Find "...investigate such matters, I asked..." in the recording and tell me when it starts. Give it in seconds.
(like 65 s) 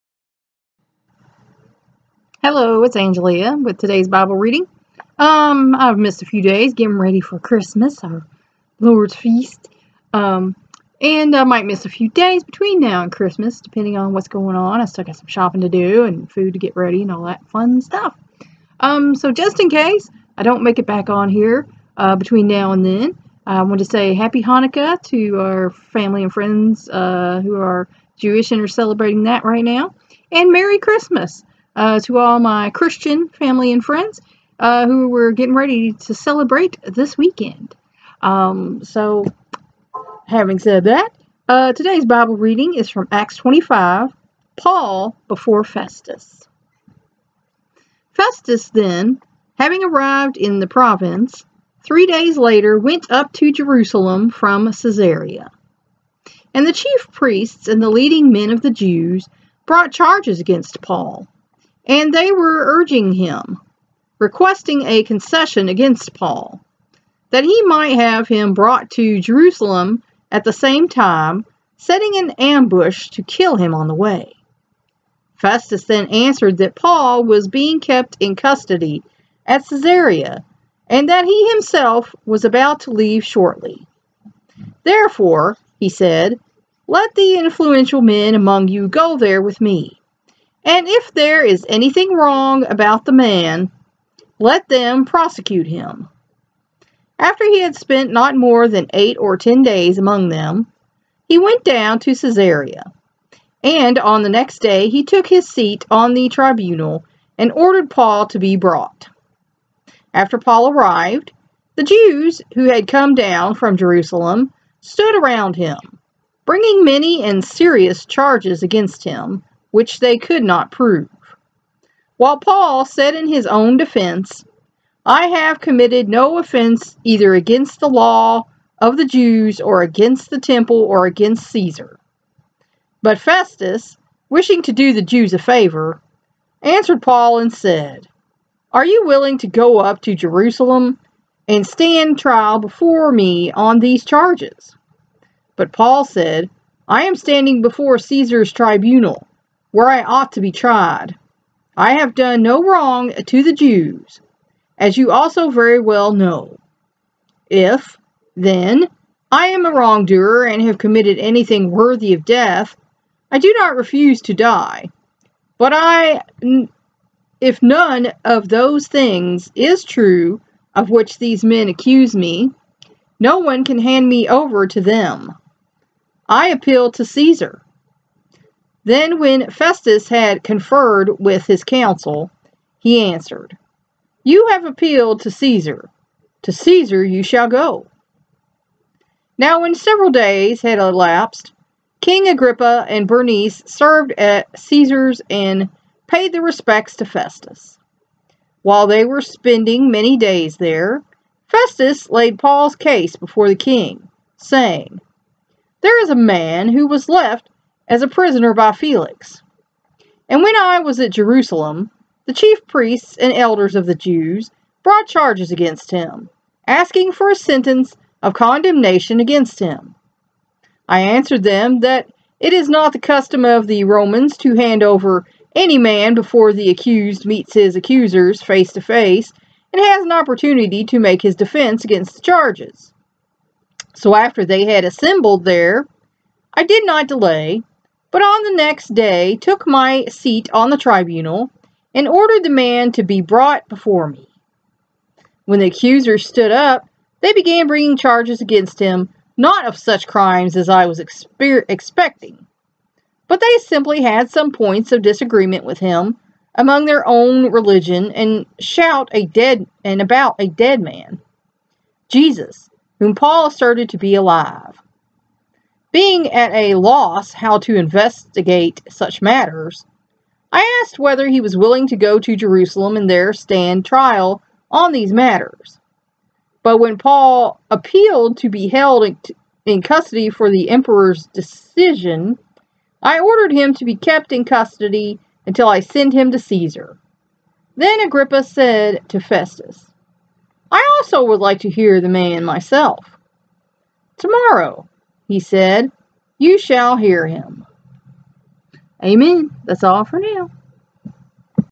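267 s.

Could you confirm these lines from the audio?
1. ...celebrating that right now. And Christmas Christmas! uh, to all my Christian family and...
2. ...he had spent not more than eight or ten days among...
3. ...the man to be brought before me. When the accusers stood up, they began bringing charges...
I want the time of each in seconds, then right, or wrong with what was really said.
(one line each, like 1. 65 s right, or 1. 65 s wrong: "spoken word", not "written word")
1. 28 s wrong: "Merry", not "Christmas"
2. 97 s right
3. 242 s right.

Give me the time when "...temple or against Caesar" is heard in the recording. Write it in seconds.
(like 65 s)
130 s.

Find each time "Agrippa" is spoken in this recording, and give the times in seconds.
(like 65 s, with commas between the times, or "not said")
192 s, 287 s.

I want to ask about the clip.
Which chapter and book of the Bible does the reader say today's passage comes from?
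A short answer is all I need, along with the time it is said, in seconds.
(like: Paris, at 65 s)
Acts 25, at 43 s.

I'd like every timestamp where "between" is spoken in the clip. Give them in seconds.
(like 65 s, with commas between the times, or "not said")
12 s, 22 s.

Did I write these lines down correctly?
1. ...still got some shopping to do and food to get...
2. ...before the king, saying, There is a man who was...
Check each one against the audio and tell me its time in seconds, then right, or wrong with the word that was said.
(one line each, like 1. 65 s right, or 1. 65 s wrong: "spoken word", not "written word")
1. 14 s right
2. 203 s right.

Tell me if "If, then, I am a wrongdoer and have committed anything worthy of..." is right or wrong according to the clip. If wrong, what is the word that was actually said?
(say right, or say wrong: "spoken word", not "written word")
right.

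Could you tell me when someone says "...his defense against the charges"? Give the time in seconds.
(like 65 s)
231 s.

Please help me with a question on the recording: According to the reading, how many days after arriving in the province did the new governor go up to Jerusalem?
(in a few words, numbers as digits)
3.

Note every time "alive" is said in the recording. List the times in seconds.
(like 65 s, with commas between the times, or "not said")
264 s.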